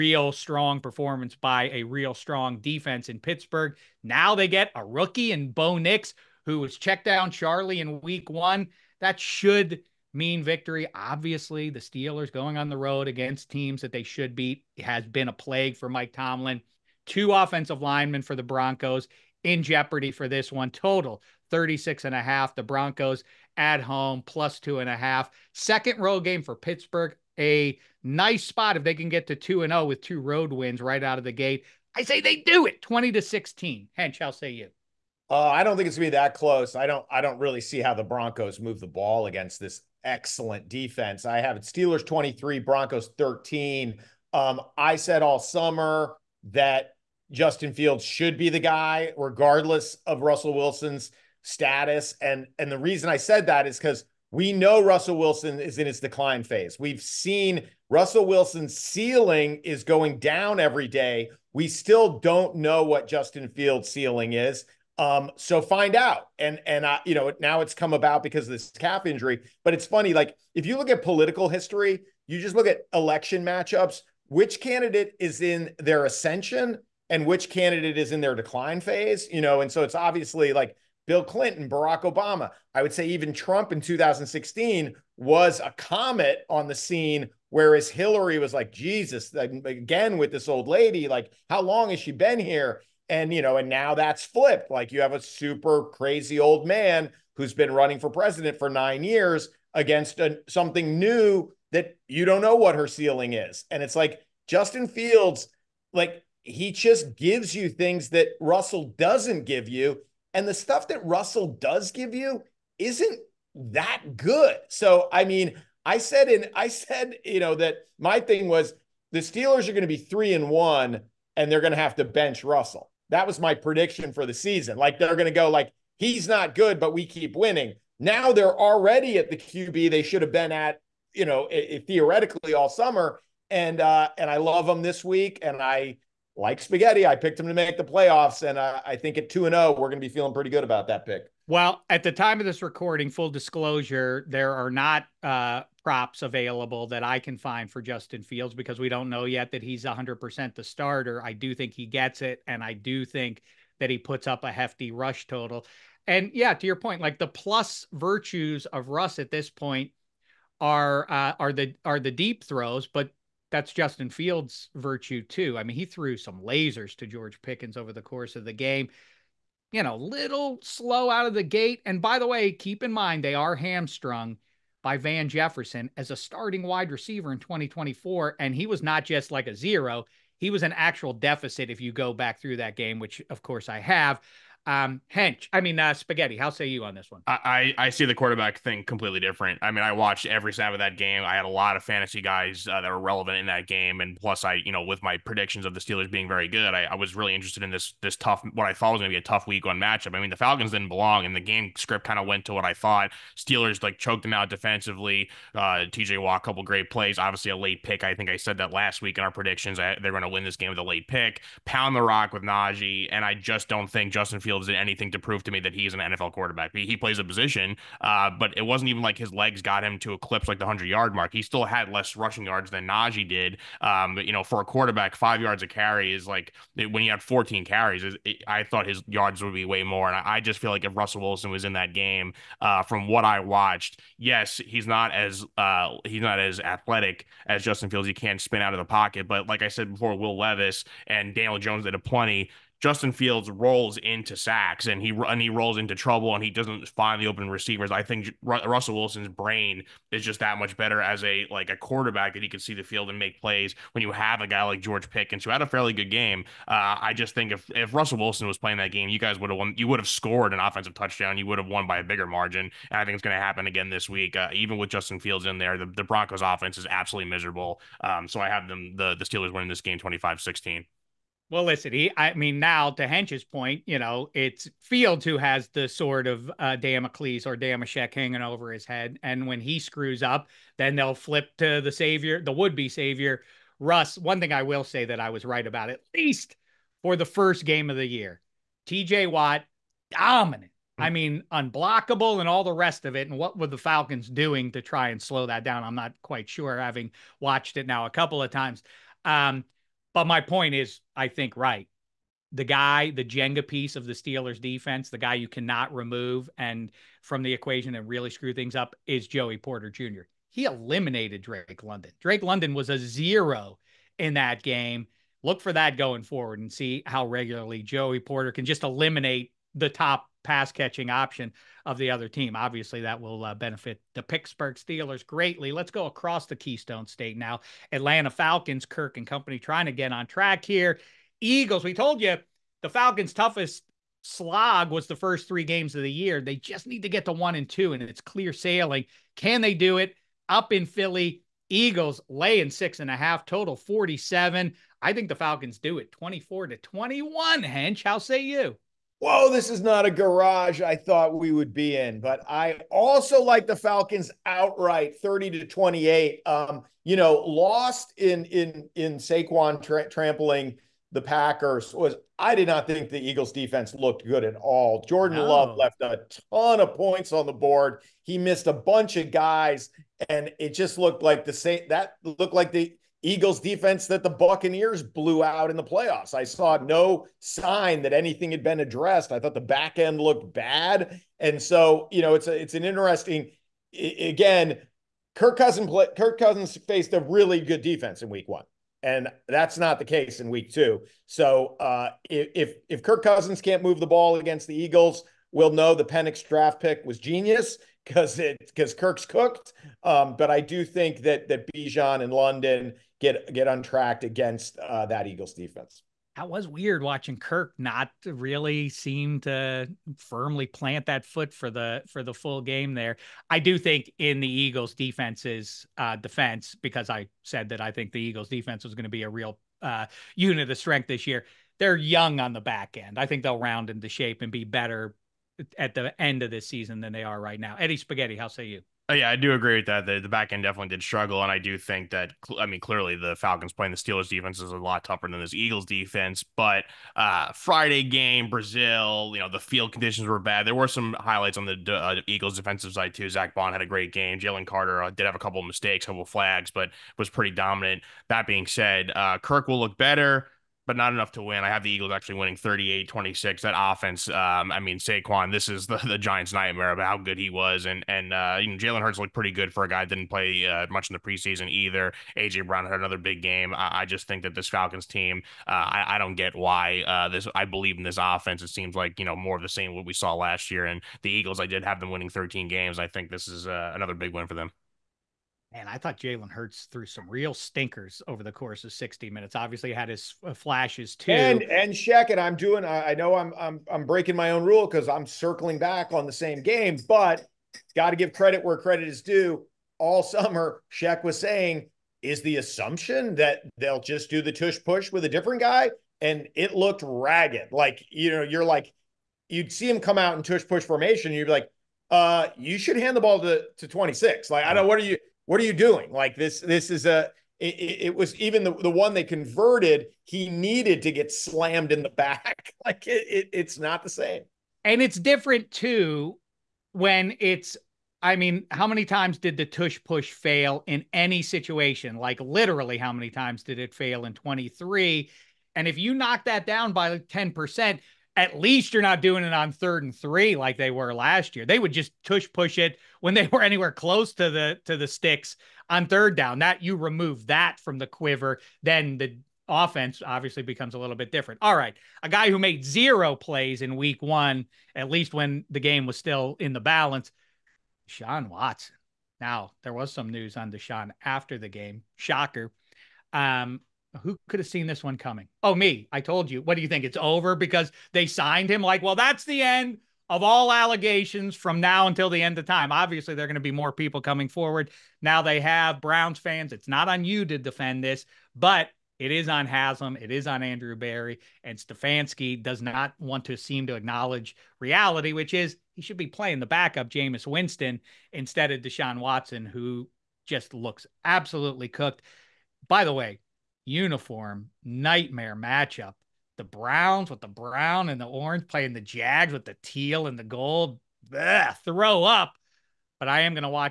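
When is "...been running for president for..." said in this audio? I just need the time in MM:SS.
01:37.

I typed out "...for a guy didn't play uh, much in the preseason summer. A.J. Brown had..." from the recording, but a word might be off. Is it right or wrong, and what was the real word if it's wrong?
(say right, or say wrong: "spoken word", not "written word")
wrong: "either", not "summer".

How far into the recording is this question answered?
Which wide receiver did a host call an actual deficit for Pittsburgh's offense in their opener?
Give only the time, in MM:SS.
02:54.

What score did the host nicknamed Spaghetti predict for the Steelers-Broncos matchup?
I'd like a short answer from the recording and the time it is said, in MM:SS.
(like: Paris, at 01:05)
25-16, at 04:29.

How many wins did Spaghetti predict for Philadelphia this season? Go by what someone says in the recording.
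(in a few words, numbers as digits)
13.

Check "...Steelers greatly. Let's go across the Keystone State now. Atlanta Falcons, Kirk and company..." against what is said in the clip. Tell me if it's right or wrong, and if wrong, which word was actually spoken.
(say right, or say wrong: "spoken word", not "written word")
right.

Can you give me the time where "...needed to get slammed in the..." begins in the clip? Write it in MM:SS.
08:30.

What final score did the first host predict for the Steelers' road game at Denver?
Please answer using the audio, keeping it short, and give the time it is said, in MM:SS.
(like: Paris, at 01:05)
20 to 16, at 00:32.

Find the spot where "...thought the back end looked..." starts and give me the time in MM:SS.
06:19.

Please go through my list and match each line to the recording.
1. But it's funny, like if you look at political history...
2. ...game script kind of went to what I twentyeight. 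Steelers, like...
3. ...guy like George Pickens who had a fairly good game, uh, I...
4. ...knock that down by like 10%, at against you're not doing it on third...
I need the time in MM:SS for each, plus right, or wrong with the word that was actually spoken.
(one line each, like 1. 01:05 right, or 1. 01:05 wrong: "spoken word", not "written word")
1. 01:09 right
2. 03:21 wrong: "thought", not "twentyeight"
3. 04:14 right
4. 08:46 wrong: "least", not "against".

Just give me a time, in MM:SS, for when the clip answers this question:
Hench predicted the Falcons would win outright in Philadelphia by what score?
05:55.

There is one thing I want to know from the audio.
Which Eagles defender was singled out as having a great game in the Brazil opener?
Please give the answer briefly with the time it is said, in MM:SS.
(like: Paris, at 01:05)
Zack Baun, at 07:23.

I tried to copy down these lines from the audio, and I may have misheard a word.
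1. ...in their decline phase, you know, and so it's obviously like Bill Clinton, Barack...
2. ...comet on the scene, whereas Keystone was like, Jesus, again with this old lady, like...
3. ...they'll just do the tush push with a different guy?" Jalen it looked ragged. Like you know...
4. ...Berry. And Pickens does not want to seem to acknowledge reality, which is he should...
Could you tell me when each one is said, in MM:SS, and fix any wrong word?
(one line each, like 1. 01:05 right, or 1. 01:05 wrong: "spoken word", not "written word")
1. 01:18 right
2. 01:25 wrong: "Hillary", not "Keystone"
3. 08:13 wrong: "And", not "Jalen"
4. 09:30 wrong: "Stefanski", not "Pickens".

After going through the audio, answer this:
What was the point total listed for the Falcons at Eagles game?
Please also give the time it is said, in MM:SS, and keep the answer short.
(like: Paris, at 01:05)
47, at 05:43.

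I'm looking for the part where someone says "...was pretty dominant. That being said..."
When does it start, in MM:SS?
07:27.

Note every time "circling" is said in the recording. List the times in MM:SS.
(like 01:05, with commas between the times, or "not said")
08:05.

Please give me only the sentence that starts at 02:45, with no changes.
I mean, he threw some lasers to George Pickens over the course of the game.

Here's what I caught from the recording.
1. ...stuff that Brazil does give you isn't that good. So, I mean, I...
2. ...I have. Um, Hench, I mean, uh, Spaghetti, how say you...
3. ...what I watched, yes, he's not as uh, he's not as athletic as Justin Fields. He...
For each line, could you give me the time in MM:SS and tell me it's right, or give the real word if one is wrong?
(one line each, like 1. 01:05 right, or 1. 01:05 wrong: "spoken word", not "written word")
1. 01:50 wrong: "Russell", not "Brazil"
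2. 03:03 right
3. 03:53 right.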